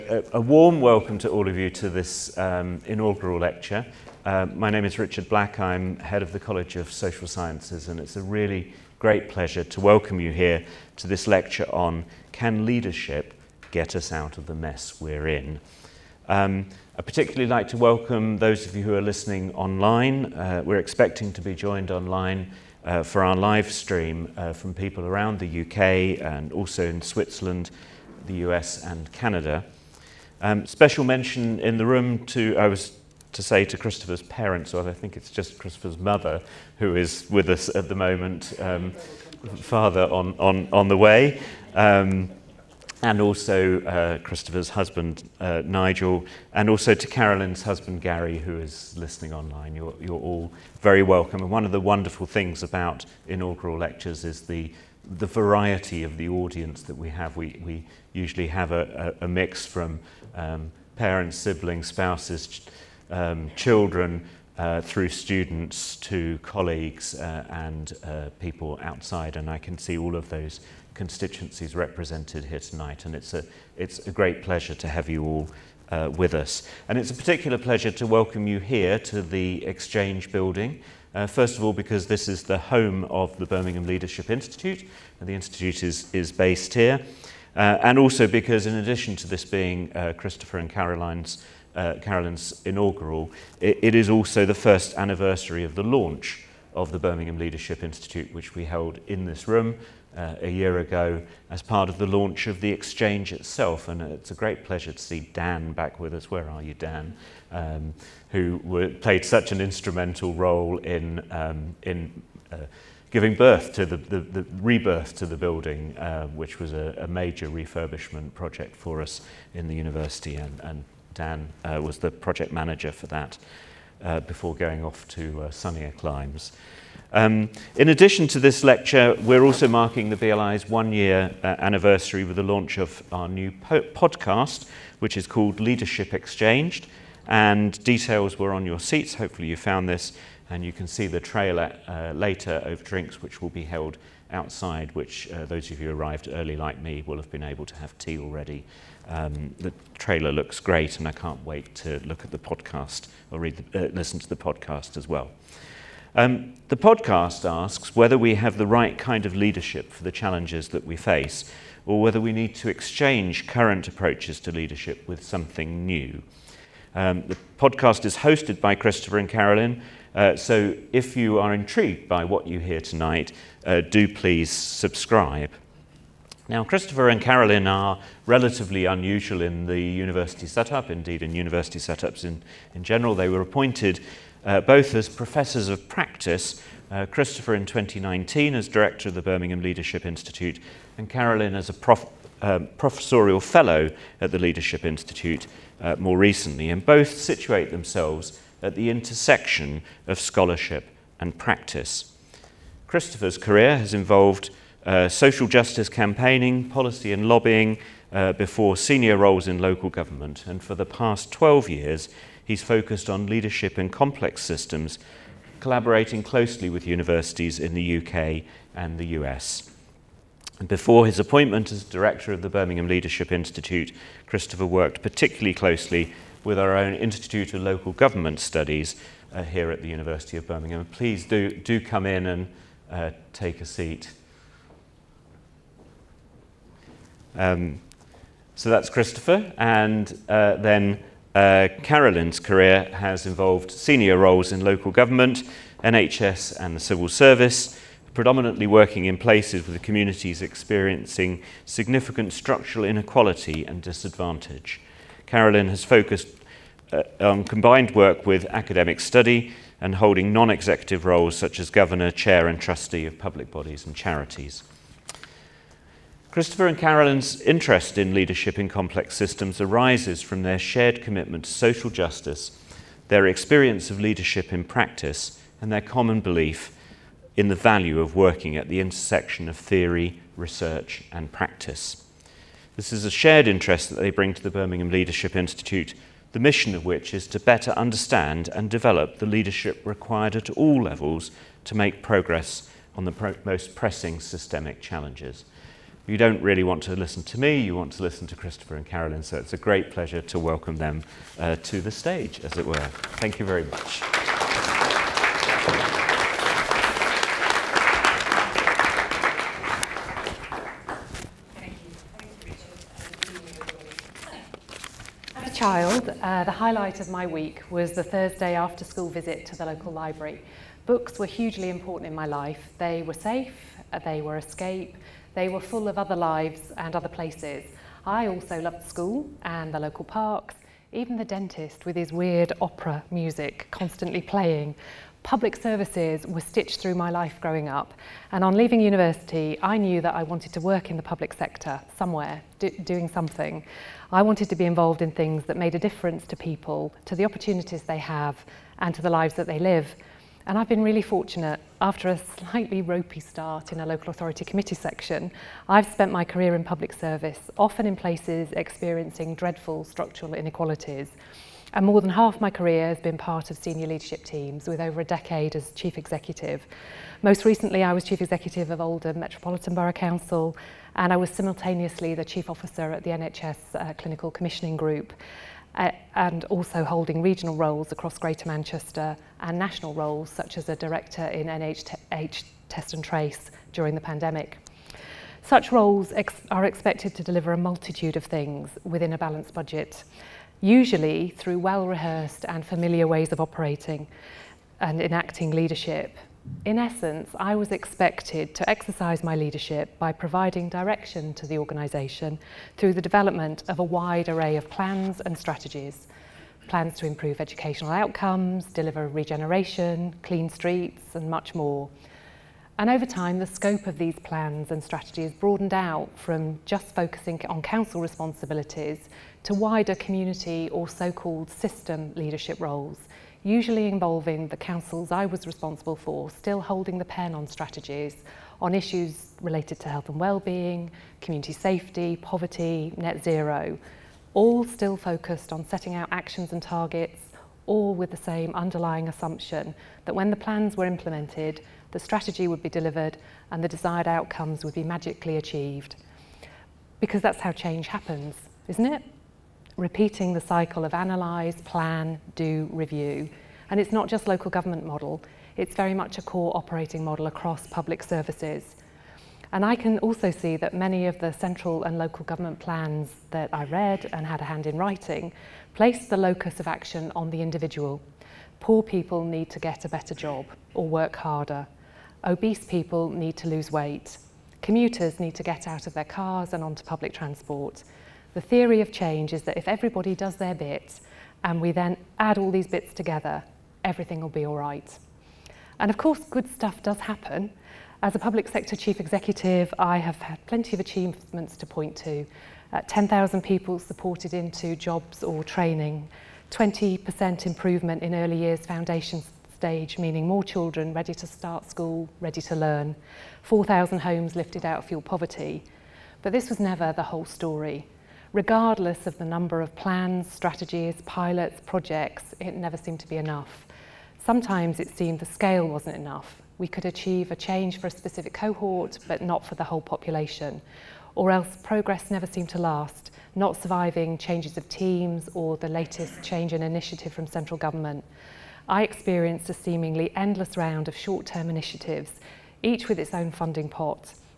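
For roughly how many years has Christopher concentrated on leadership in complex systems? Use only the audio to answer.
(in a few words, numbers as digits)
12 years.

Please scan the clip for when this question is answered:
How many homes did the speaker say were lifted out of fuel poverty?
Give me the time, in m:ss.
8:23.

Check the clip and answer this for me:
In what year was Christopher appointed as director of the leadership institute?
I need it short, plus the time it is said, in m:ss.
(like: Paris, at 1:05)
2019, at 3:07.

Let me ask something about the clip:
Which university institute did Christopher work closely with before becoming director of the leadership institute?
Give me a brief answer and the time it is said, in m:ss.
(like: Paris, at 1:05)
Institute of Local Government Studies, at 3:46.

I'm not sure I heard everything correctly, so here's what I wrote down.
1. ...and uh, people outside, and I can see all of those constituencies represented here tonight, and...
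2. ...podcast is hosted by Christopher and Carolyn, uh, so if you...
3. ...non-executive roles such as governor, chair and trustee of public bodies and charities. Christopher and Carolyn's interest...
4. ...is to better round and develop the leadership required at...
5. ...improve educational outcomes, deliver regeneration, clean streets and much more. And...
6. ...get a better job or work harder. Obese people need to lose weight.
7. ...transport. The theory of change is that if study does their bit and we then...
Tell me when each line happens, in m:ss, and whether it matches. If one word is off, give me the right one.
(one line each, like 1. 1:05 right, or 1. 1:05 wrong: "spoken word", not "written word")
1. 1:07 right
2. 2:47 right
3. 4:20 right
4. 4:47 wrong: "understand", not "round"
5. 6:47 right
6. 7:49 right
7. 7:57 wrong: "everybody", not "study".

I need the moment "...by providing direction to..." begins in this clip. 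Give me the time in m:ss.
6:39.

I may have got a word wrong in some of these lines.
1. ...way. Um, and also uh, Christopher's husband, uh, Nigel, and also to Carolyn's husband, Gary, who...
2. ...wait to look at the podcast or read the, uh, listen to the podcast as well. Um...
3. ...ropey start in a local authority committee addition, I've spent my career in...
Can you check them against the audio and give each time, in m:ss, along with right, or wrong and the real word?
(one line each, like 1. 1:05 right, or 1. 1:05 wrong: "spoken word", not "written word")
1. 0:40 right
2. 2:31 right
3. 5:52 wrong: "section", not "addition".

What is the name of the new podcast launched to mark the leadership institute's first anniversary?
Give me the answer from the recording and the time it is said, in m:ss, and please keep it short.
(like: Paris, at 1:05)
Leadership Exchanged, at 2:15.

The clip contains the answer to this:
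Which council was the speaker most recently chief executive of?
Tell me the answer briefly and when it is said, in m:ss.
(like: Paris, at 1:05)
Oldham Metropolitan Borough Council, at 6:08.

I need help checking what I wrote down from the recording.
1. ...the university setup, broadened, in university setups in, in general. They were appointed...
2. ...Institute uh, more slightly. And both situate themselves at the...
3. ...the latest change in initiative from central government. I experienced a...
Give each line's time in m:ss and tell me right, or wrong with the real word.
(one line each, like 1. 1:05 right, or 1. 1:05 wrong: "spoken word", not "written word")
1. 2:59 wrong: "indeed", not "broadened"
2. 3:14 wrong: "recently", not "slightly"
3. 8:45 right.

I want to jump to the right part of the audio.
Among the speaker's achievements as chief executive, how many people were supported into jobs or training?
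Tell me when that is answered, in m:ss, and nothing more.
8:12.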